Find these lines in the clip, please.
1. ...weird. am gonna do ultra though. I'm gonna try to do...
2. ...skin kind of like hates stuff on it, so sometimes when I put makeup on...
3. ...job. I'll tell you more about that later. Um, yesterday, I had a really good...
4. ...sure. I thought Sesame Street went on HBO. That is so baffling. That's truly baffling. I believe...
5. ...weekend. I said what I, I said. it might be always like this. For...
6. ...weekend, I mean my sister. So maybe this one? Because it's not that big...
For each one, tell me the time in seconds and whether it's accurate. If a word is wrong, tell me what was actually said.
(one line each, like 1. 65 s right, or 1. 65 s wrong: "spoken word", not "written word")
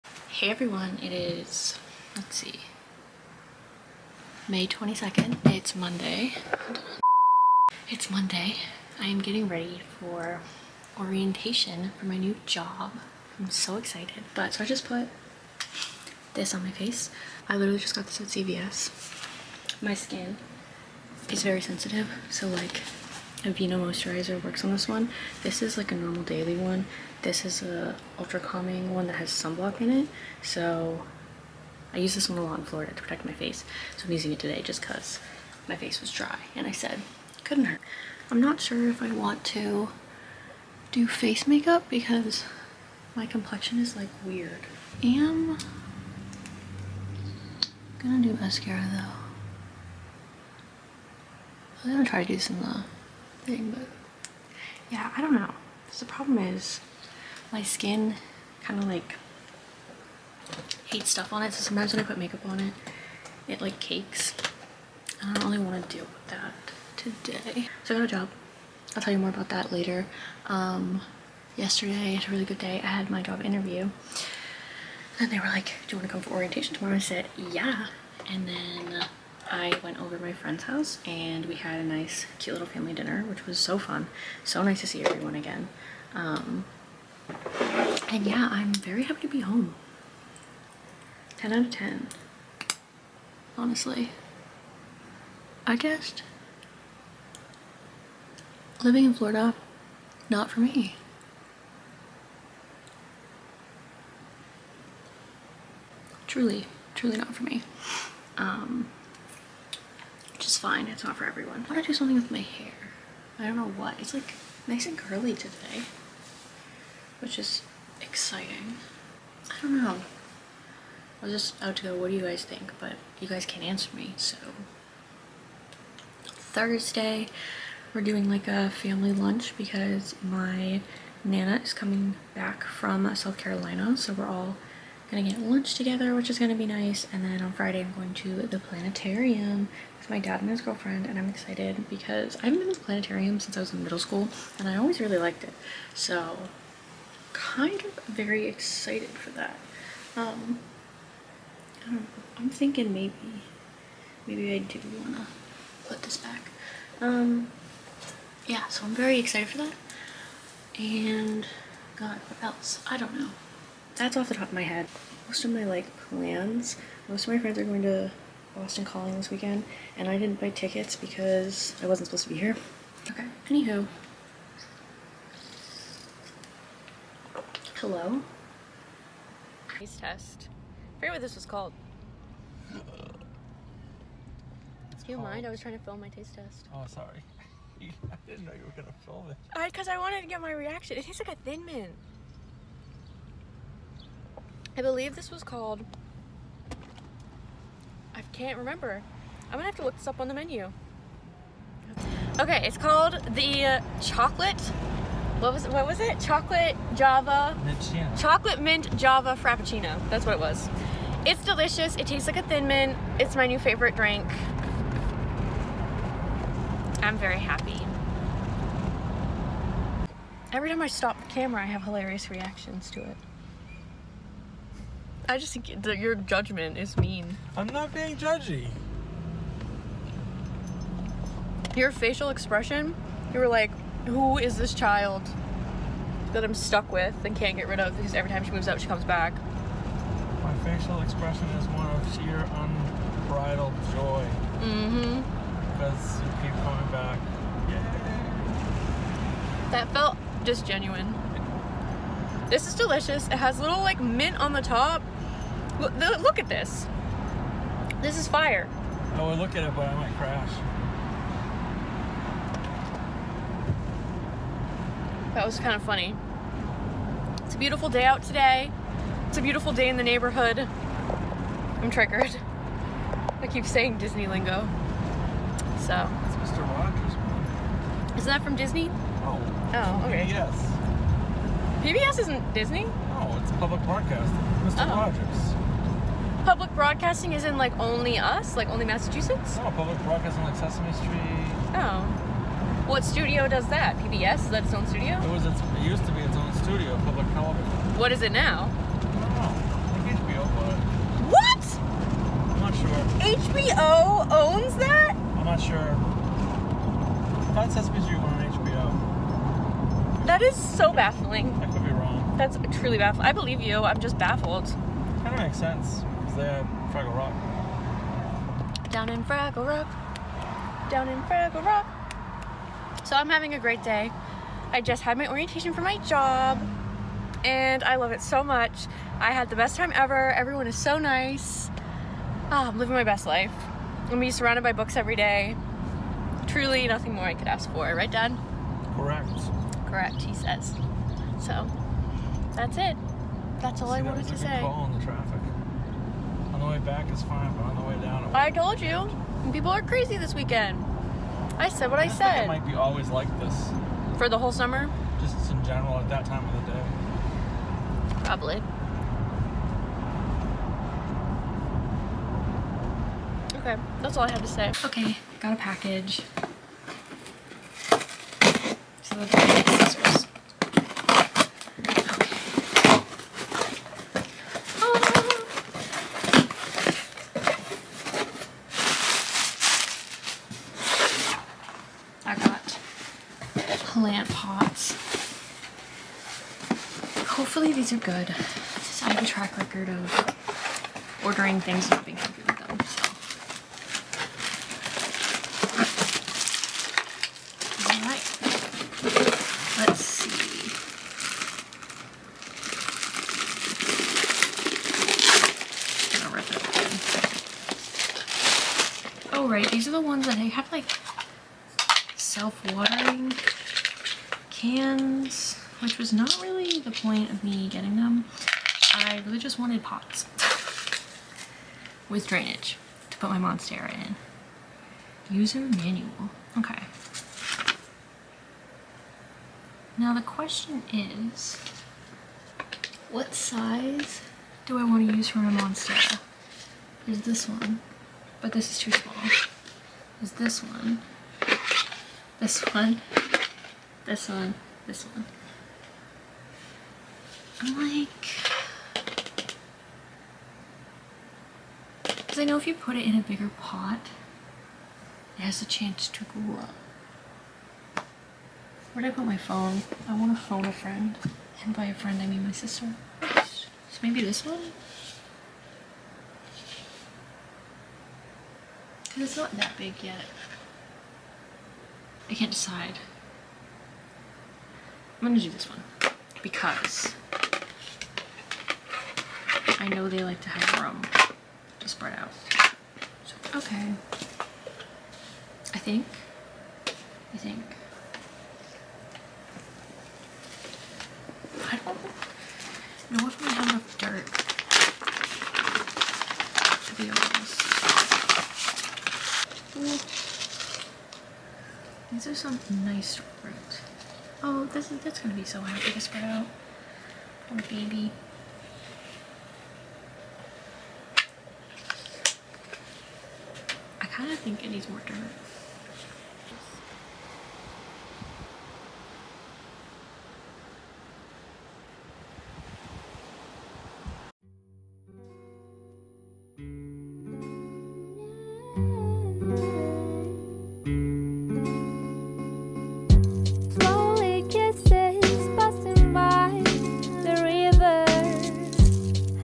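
1. 44 s wrong: "mascara", not "ultra"
2. 57 s right
3. 68 s right
4. 305 s right
5. 350 s right
6. 461 s wrong: "friend", not "weekend".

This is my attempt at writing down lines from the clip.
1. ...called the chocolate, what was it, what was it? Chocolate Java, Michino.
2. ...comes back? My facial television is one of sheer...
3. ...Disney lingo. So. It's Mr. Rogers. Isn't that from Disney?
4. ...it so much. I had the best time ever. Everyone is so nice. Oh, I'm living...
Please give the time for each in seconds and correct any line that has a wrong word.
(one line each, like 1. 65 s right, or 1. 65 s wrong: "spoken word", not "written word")
1. 202 s right
2. 238 s wrong: "expression", not "television"
3. 273 s right
4. 328 s right.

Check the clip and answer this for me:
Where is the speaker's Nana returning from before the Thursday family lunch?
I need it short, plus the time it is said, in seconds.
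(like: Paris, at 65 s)
South Carolina, at 133 s.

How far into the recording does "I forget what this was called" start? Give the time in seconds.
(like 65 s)
180 s.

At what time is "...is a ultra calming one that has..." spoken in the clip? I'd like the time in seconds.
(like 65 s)
27 s.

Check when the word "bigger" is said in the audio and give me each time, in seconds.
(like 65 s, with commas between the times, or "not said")
453 s.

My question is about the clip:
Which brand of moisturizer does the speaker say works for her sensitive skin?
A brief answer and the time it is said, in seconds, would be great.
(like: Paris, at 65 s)
Aveeno, at 23 s.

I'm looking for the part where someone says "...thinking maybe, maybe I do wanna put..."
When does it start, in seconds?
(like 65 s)
152 s.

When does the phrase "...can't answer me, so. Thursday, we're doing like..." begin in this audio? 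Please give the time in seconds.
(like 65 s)
123 s.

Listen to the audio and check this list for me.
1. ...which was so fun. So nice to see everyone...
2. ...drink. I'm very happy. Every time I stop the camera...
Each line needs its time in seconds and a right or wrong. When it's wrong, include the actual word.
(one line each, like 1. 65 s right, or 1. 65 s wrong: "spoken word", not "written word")
1. 83 s right
2. 213 s right.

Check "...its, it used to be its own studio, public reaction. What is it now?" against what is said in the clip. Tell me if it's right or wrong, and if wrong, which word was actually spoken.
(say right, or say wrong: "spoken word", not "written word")
wrong: "television", not "reaction".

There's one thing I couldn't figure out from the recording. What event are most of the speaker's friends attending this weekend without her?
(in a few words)
Boston Calling.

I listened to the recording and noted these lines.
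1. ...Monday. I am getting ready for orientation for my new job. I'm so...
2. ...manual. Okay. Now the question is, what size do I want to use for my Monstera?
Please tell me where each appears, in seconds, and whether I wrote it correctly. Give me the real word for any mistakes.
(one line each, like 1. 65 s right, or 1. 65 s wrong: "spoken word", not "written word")
1. 8 s right
2. 425 s right.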